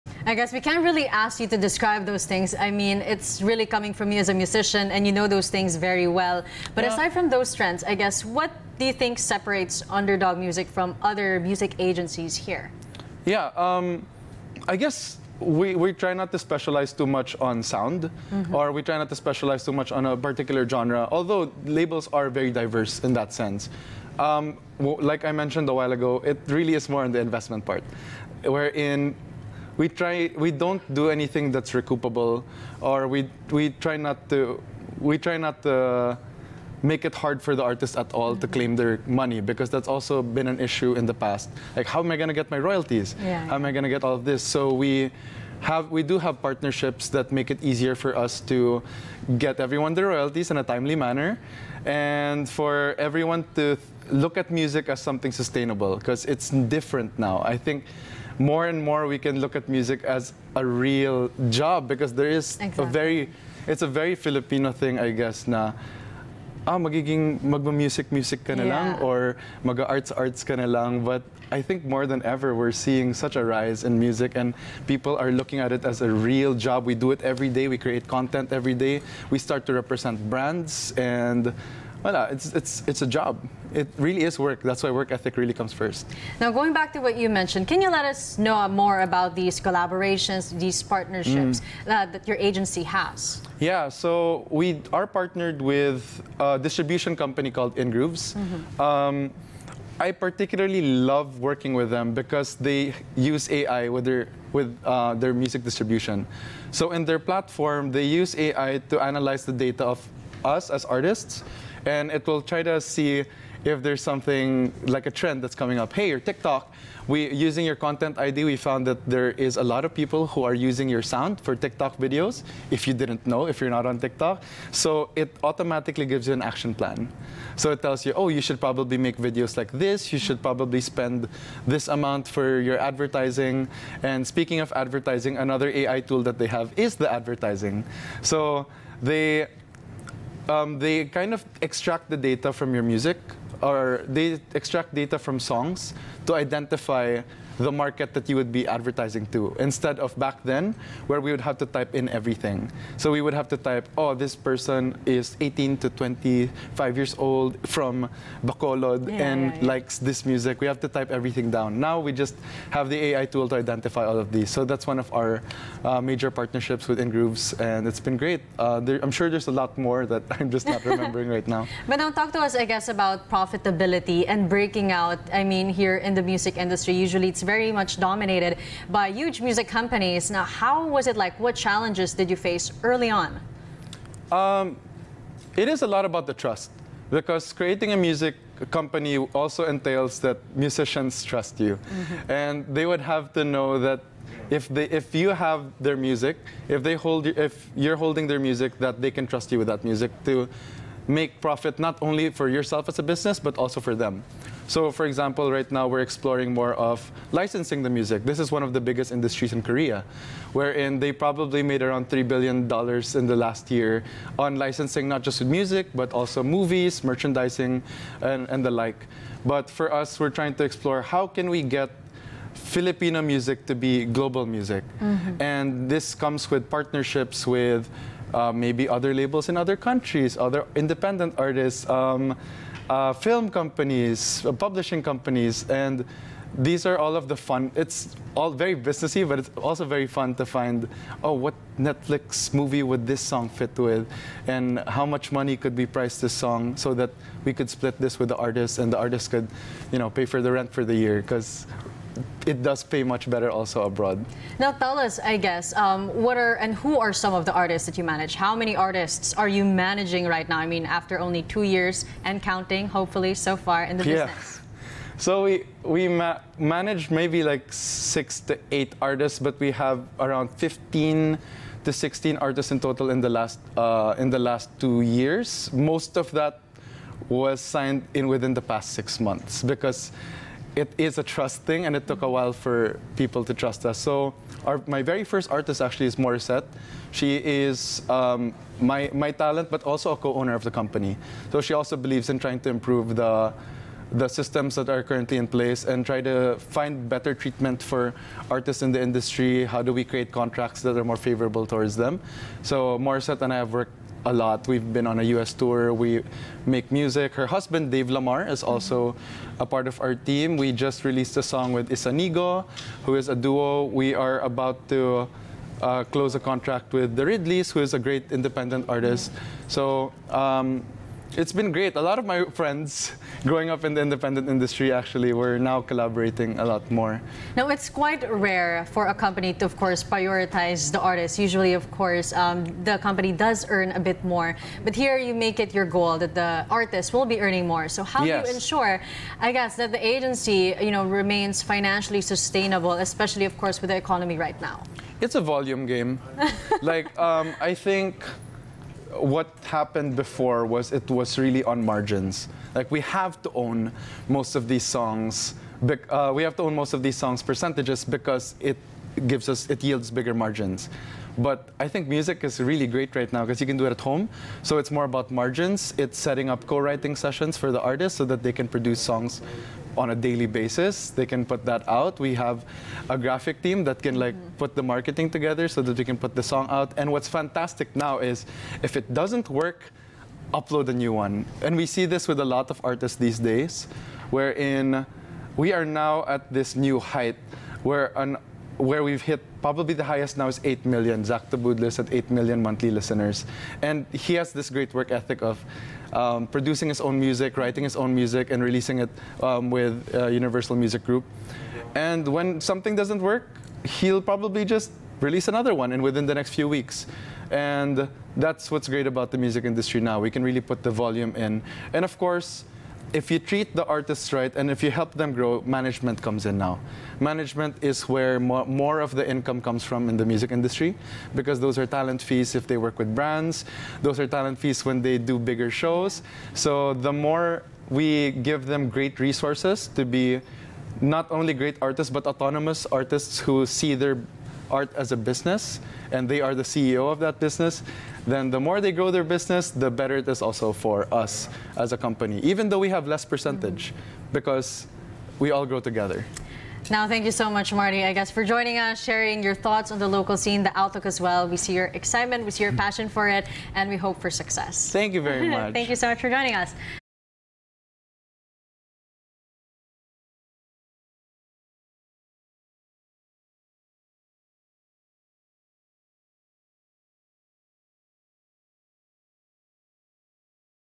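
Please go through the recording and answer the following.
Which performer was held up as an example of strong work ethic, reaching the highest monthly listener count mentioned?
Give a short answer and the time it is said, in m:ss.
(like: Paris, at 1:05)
Zack Tabudlo, at 6:31.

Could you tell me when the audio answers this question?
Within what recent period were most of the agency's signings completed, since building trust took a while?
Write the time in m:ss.
4:38.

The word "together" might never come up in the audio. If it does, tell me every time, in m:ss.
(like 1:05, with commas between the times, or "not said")
6:15, 7:25.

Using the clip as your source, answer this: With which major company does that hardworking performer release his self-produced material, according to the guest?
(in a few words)
Universal Music Group.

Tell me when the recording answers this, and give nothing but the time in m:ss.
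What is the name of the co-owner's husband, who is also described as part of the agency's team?
5:07.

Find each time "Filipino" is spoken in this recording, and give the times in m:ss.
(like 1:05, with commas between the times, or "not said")
1:04, 3:42.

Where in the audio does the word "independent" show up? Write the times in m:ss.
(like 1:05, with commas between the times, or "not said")
3:50, 5:18, 5:24.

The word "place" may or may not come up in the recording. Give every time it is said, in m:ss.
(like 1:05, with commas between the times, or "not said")
4:55.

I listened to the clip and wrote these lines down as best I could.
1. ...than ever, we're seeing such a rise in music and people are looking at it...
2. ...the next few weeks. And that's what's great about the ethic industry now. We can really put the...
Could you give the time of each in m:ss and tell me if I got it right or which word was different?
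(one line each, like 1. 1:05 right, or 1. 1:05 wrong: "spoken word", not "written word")
1. 1:12 right
2. 6:46 wrong: "music", not "ethic".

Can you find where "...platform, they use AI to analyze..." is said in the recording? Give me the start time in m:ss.
1:47.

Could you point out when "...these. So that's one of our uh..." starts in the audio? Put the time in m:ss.
2:44.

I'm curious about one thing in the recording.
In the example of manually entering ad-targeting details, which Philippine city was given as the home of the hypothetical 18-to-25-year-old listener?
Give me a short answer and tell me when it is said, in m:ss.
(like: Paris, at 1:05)
Bacolod, at 2:38.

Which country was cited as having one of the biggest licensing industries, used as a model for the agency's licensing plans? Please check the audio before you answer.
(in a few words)
Korea.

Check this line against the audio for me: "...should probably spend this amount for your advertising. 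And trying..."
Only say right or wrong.
wrong.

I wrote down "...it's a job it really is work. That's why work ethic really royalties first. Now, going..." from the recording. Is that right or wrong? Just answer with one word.
wrong.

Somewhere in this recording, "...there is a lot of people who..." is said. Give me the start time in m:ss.
1:59.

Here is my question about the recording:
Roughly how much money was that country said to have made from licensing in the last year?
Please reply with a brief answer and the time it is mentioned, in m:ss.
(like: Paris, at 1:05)
$3 billion, at 3:32.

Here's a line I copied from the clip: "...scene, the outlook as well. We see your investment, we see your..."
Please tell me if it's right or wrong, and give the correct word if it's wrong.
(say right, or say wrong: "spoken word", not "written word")
wrong: "excitement", not "investment".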